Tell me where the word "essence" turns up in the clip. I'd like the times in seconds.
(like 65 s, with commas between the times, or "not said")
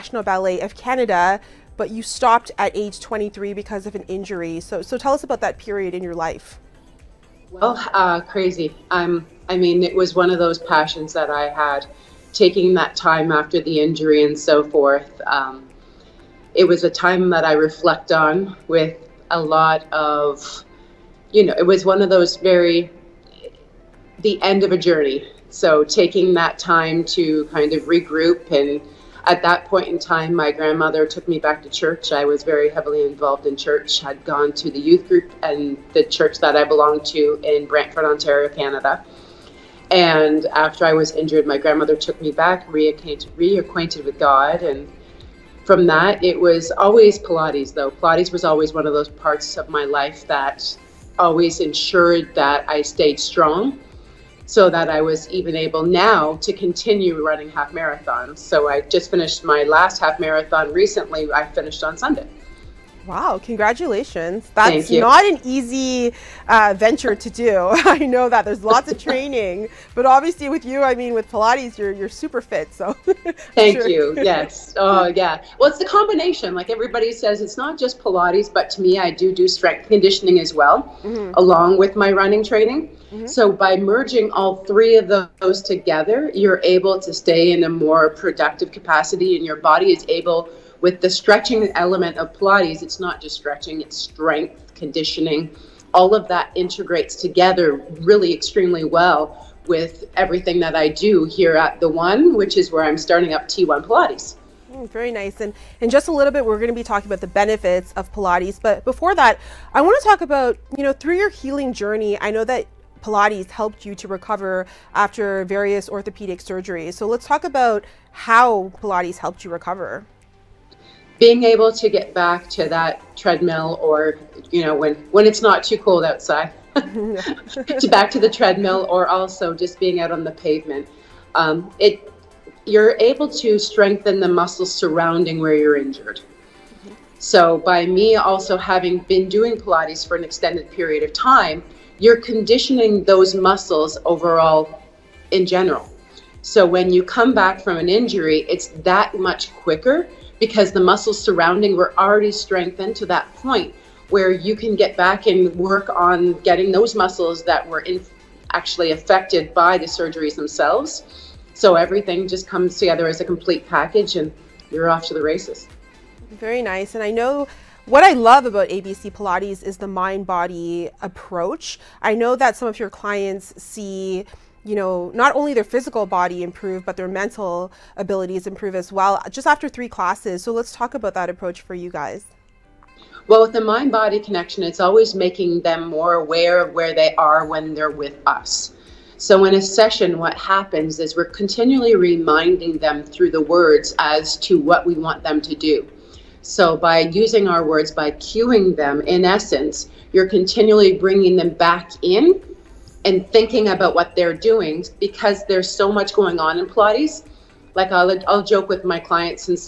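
199 s.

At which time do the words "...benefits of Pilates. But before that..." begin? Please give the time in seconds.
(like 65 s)
107 s.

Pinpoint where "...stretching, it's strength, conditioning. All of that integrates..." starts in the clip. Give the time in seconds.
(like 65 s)
93 s.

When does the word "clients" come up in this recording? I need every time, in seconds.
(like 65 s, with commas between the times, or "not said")
172 s, 208 s.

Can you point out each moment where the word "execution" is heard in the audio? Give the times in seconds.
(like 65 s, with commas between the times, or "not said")
not said.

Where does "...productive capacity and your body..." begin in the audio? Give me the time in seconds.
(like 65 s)
88 s.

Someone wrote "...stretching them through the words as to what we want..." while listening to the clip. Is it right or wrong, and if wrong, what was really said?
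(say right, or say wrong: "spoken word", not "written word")
wrong: "reminding", not "stretching".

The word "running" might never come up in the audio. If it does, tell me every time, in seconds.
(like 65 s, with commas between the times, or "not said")
57 s, 82 s.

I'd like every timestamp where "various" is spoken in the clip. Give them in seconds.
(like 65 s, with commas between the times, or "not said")
115 s.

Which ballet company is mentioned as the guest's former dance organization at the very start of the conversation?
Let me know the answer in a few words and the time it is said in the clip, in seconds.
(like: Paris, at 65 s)
Ballet of Canada, at 0 s.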